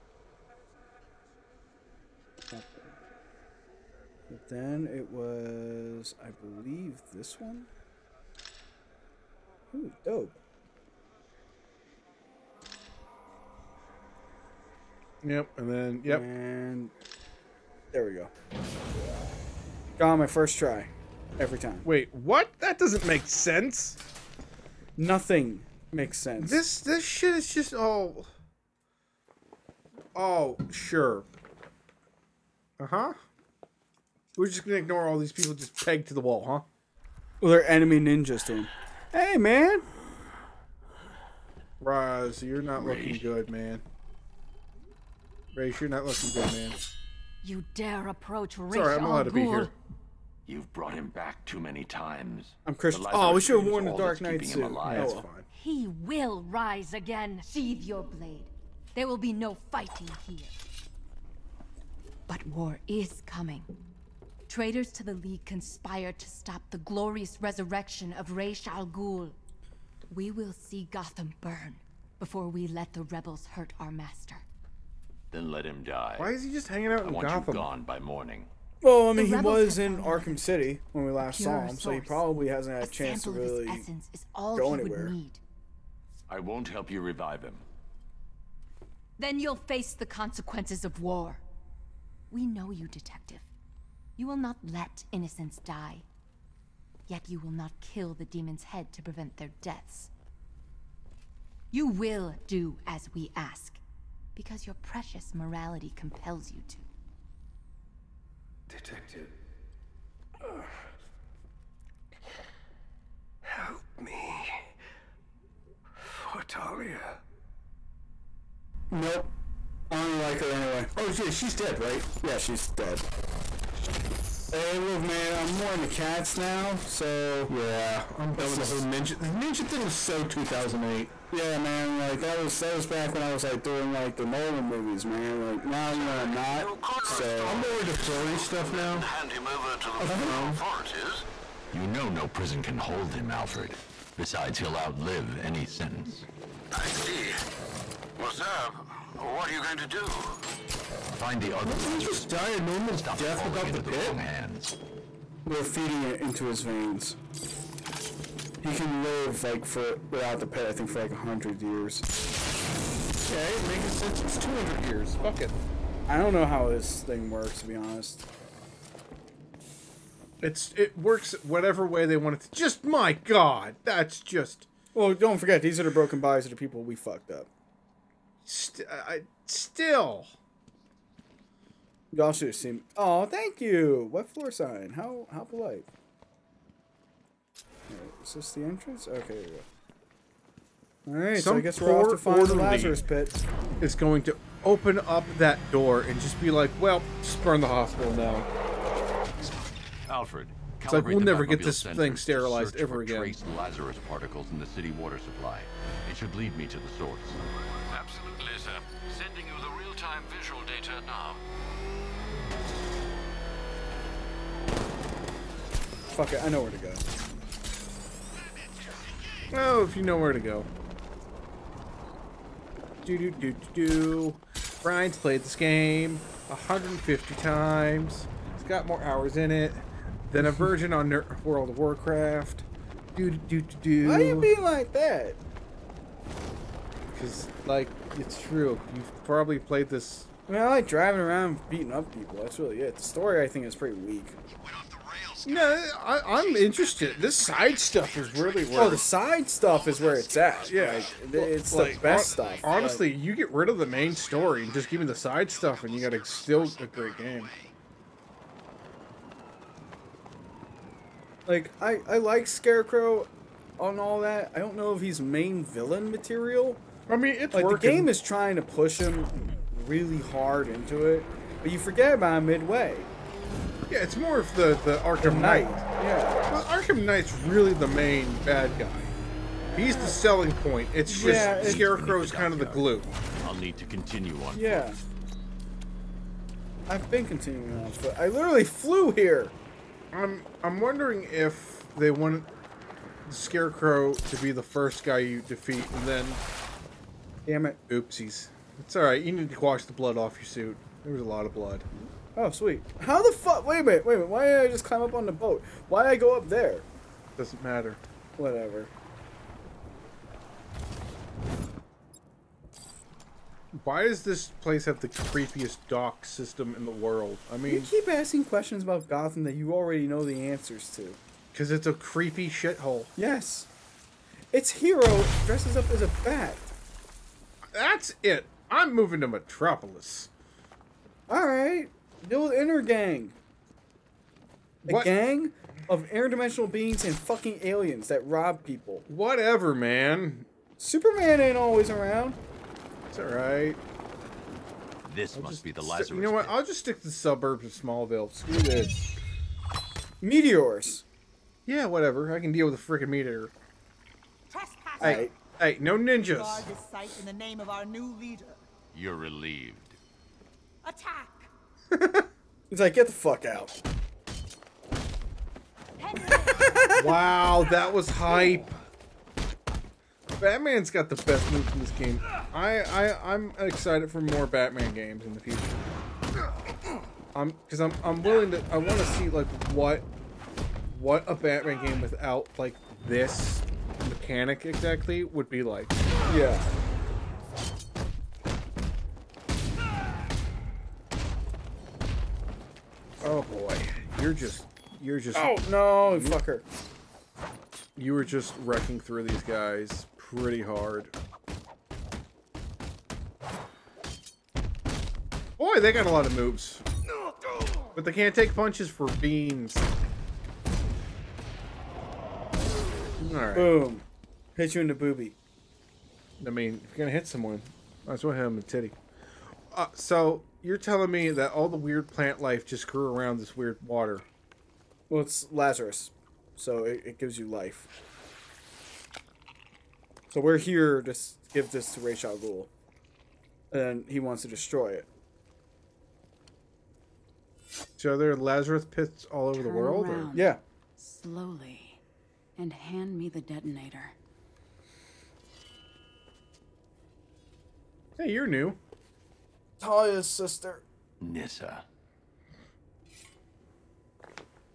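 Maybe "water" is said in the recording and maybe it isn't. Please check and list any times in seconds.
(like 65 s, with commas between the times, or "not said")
204 s, 423 s.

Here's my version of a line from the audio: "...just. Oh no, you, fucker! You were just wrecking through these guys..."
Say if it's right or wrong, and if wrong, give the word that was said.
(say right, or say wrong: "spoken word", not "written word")
right.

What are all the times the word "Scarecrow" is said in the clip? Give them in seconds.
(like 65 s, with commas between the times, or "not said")
262 s, 281 s, 293 s.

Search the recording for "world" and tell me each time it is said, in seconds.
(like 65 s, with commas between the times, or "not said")
231 s, 316 s, 439 s.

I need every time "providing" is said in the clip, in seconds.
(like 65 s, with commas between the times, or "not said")
not said.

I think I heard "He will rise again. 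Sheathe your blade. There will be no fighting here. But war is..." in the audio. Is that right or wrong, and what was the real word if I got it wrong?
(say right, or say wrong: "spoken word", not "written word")
right.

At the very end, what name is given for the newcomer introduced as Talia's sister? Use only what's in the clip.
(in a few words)
Nissa.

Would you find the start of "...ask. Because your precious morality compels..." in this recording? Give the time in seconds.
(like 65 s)
103 s.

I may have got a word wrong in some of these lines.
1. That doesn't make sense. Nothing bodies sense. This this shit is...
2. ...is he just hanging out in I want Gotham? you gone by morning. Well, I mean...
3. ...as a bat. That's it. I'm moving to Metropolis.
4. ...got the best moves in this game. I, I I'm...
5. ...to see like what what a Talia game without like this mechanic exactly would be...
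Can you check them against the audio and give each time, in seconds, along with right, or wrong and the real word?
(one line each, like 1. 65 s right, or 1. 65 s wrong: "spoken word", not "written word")
1. 22 s wrong: "makes", not "bodies"
2. 76 s right
3. 325 s right
4. 370 s right
5. 378 s wrong: "Batman", not "Talia".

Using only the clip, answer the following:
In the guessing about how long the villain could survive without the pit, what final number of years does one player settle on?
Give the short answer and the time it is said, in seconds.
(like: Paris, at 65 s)
200, at 164 s.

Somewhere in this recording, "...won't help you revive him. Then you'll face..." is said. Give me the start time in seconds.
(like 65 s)
86 s.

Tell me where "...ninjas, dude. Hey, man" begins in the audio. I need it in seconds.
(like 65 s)
38 s.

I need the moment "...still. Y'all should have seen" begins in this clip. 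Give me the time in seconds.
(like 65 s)
179 s.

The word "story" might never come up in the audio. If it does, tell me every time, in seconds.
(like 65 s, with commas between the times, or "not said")
243 s, 254 s.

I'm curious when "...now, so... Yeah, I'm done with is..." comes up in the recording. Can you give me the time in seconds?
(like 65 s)
126 s.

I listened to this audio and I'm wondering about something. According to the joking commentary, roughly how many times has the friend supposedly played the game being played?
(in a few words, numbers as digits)
150.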